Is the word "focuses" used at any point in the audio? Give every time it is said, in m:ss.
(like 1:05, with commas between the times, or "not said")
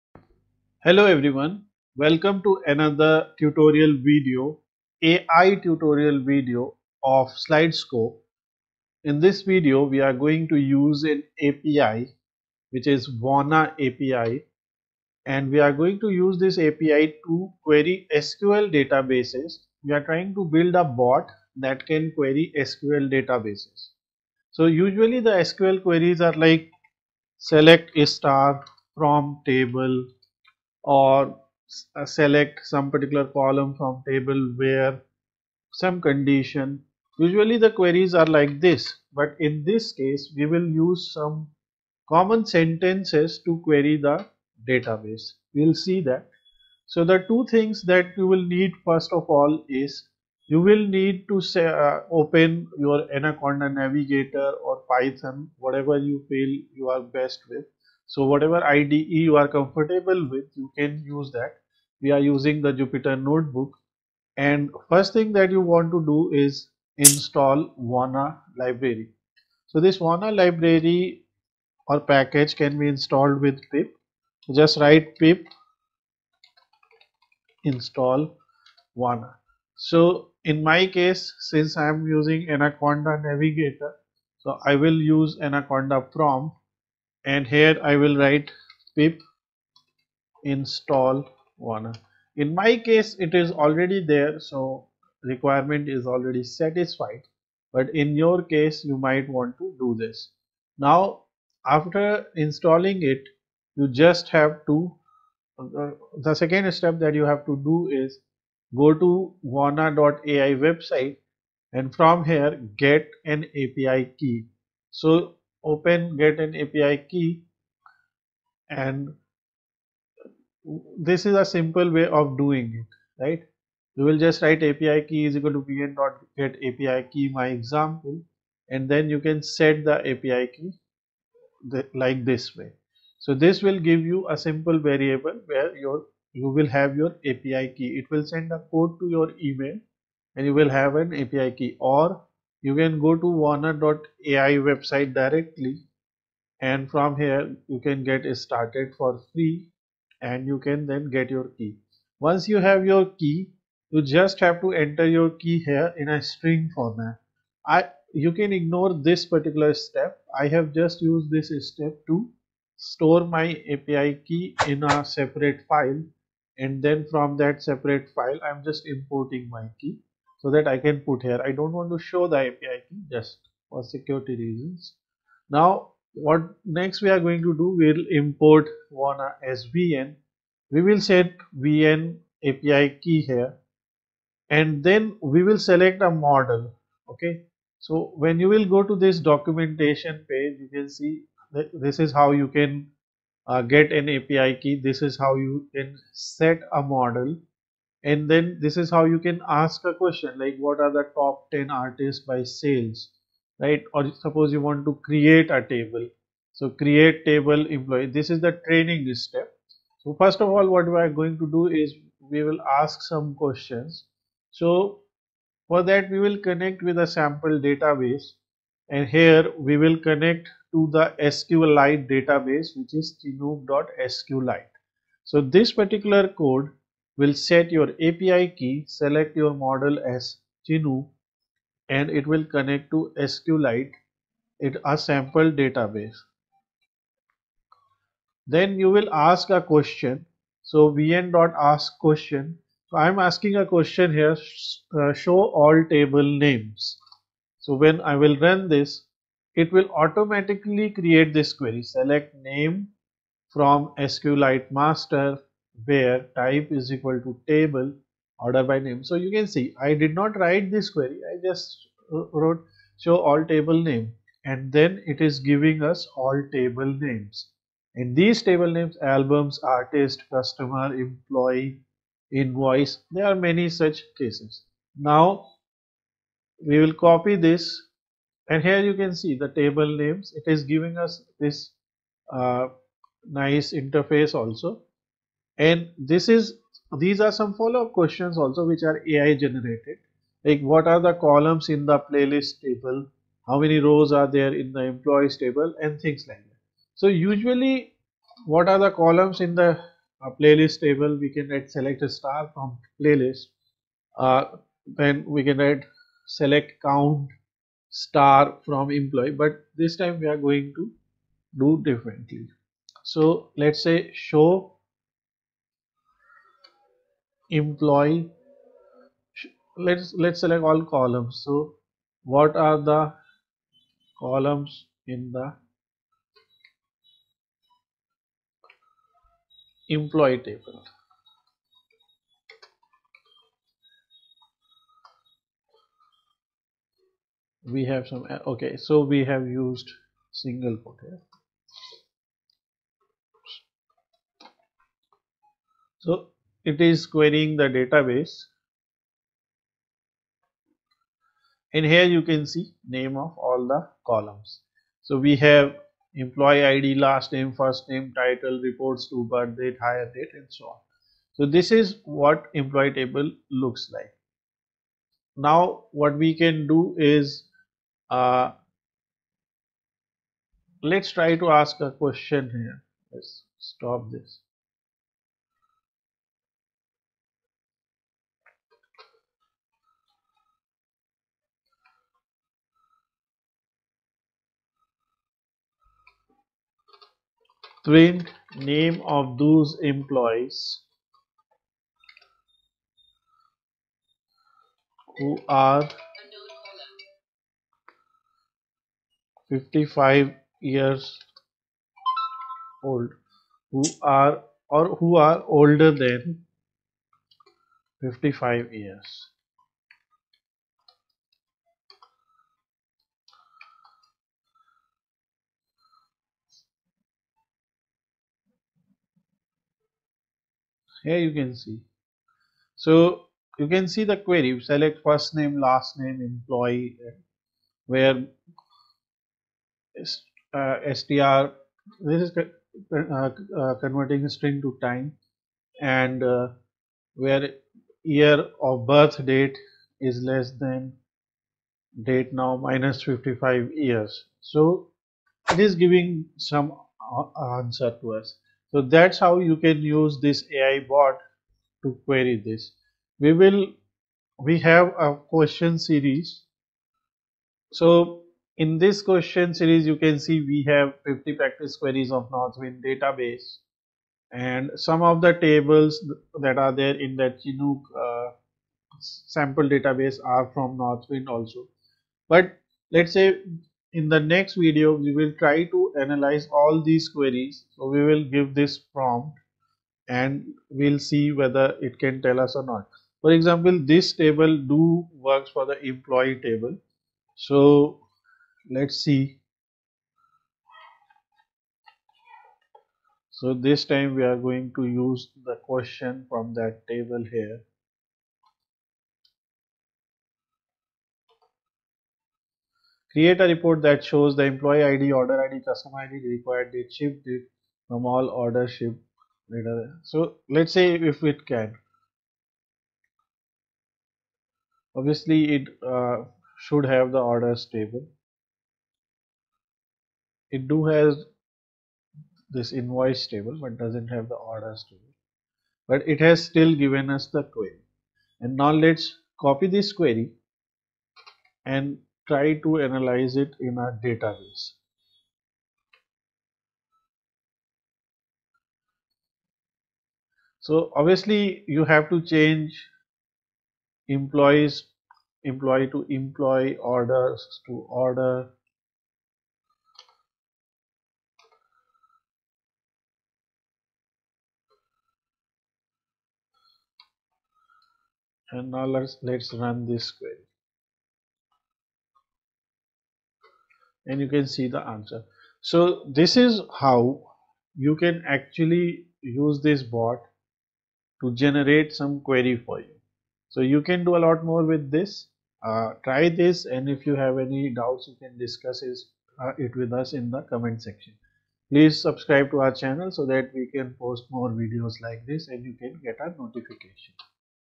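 not said.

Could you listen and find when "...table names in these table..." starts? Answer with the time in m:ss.
4:26.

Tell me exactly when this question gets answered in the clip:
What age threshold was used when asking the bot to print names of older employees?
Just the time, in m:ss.
6:39.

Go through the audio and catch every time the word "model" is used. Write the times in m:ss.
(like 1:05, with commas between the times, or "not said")
3:06, 3:16, 3:49.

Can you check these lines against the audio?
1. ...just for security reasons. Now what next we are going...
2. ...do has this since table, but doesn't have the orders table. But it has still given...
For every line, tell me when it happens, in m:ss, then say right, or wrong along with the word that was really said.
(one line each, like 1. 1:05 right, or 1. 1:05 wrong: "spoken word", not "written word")
1. 2:53 right
2. 8:40 wrong: "invoice", not "since".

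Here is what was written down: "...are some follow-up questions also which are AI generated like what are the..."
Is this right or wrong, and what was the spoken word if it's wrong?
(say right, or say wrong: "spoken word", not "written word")
right.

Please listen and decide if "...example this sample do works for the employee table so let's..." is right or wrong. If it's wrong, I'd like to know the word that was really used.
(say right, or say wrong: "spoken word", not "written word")
wrong: "table", not "sample".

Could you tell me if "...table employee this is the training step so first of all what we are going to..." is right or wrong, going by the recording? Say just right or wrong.
right.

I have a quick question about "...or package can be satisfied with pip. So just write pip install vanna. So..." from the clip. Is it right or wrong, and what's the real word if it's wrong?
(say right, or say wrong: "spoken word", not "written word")
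wrong: "installed", not "satisfied".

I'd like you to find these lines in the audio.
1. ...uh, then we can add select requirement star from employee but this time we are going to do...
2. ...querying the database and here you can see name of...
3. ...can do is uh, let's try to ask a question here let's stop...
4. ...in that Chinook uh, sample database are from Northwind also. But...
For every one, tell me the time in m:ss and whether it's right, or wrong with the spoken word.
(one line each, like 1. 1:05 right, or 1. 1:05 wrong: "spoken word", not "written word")
1. 5:04 wrong: "count", not "requirement"
2. 5:47 right
3. 6:06 right
4. 7:46 right.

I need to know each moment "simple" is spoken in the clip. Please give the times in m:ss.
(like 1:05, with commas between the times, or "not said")
2:01, 2:14.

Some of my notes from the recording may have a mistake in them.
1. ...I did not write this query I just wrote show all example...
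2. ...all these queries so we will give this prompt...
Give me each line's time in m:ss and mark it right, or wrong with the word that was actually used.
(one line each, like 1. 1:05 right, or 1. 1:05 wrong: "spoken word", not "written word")
1. 4:19 wrong: "table", not "example"
2. 7:56 right.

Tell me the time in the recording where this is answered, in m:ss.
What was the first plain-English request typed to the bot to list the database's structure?
4:05.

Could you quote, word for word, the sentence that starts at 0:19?
We are trying to build a bot that can query SQL databases.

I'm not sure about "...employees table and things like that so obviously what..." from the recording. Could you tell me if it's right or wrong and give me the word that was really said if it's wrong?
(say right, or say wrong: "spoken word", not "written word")
wrong: "usually", not "obviously".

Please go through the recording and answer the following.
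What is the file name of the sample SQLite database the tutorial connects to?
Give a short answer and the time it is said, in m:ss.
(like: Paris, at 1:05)
chinook.sqlite, at 3:43.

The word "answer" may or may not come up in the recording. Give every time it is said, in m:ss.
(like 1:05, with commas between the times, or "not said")
7:27, 9:24.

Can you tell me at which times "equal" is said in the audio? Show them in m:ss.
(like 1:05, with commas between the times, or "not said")
2:05, 4:16.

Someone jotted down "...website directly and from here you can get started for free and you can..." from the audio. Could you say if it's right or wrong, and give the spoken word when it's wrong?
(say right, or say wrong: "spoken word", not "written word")
right.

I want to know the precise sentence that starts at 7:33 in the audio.
We will, we have a question series.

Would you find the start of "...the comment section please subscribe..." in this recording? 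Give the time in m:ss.
9:40.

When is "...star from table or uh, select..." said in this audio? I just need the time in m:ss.
0:28.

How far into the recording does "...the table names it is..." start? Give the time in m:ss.
4:39.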